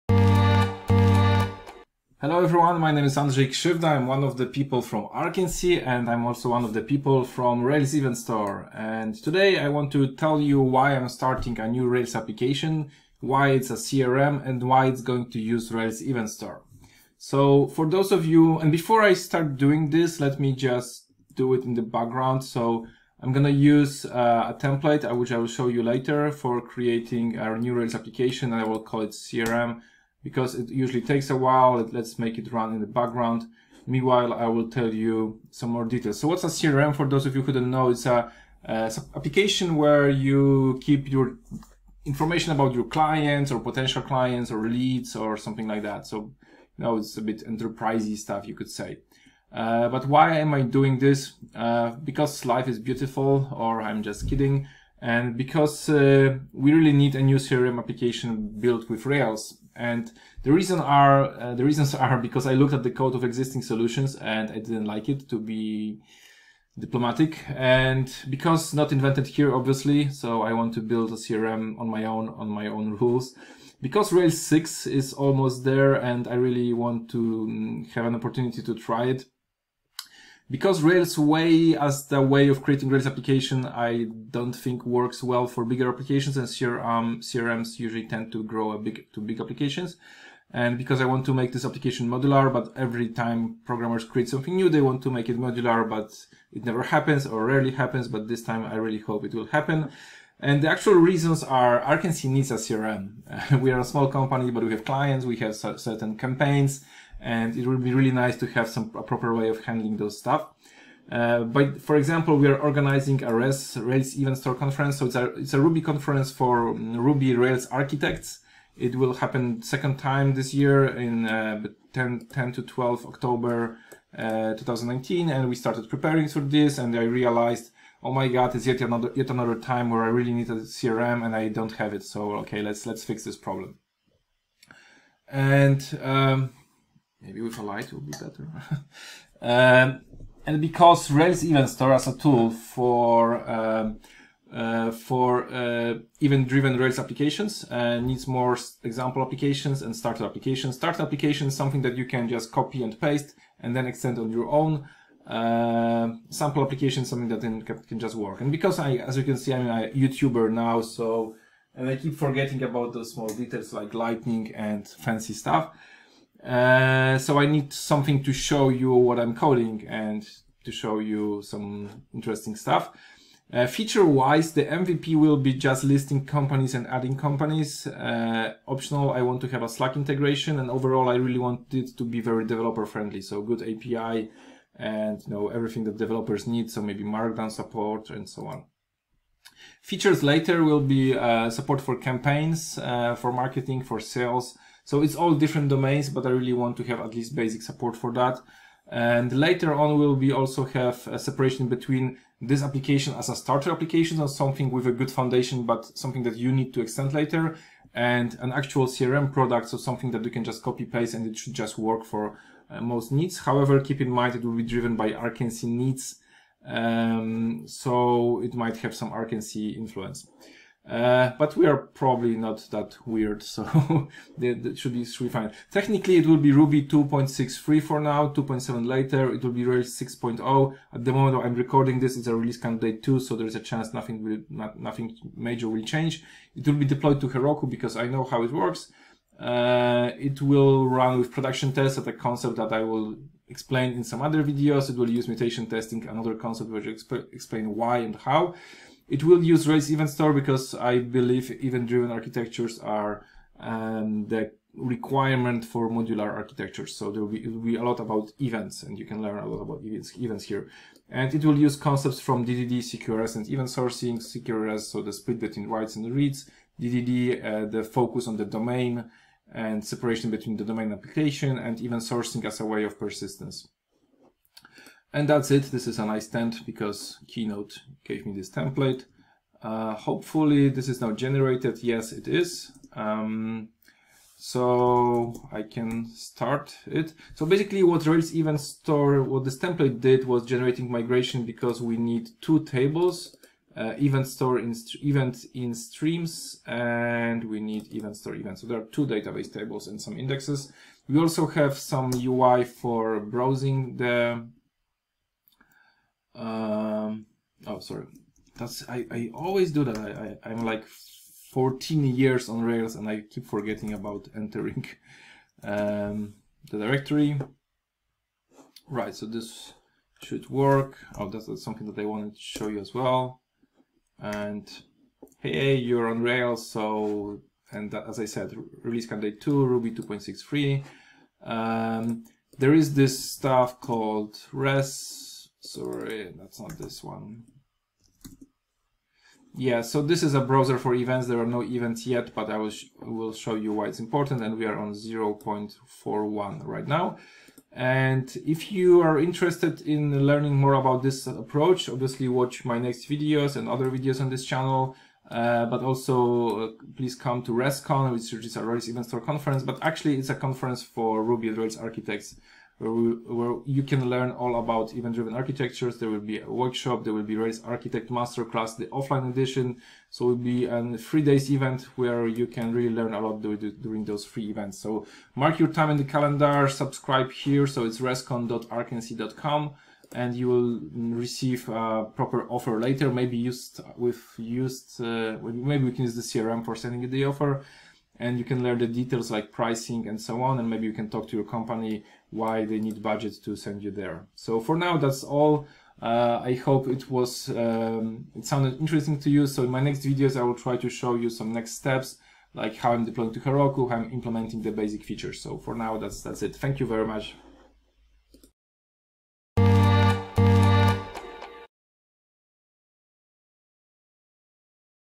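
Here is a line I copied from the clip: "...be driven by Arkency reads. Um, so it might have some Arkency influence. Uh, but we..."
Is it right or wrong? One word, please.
wrong.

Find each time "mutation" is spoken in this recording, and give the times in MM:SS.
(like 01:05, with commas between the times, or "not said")
04:05.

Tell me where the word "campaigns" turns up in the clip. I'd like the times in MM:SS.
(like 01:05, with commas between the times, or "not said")
01:46, 03:11.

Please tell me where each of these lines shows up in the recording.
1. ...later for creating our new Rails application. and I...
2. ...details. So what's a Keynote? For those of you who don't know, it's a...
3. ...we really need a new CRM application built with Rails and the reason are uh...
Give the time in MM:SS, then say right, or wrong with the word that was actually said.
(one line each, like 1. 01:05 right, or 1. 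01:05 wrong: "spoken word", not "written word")
1. 00:25 right
2. 00:35 wrong: "CRM", not "Keynote"
3. 00:56 right.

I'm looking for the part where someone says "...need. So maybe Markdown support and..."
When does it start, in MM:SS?
03:06.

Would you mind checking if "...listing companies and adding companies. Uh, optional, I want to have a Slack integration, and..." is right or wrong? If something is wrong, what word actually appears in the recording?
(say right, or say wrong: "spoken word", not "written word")
right.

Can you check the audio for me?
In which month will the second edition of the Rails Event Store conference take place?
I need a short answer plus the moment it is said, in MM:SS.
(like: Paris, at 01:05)
October, at 02:03.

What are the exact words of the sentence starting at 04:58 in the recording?
So there are two database tables and some indexes.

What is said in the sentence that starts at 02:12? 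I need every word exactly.
So, okay, let's, let's fix this problem.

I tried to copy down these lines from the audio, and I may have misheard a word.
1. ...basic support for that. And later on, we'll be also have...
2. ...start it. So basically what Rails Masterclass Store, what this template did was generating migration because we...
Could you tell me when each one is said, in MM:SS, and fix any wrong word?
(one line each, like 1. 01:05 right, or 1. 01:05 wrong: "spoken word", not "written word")
1. 03:17 right
2. 04:46 wrong: "Event", not "Masterclass".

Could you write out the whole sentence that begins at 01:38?
But this time I really hope it will happen.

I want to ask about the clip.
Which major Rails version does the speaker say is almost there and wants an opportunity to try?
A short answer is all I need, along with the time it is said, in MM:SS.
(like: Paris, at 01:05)
Rails 6, at 01:14.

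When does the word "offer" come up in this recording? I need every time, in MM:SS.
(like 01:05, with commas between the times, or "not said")
06:22, 06:27.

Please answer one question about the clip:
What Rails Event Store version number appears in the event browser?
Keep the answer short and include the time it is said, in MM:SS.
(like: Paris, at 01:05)
0.41, at 05:44.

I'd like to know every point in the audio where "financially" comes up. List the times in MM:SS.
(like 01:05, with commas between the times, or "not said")
not said.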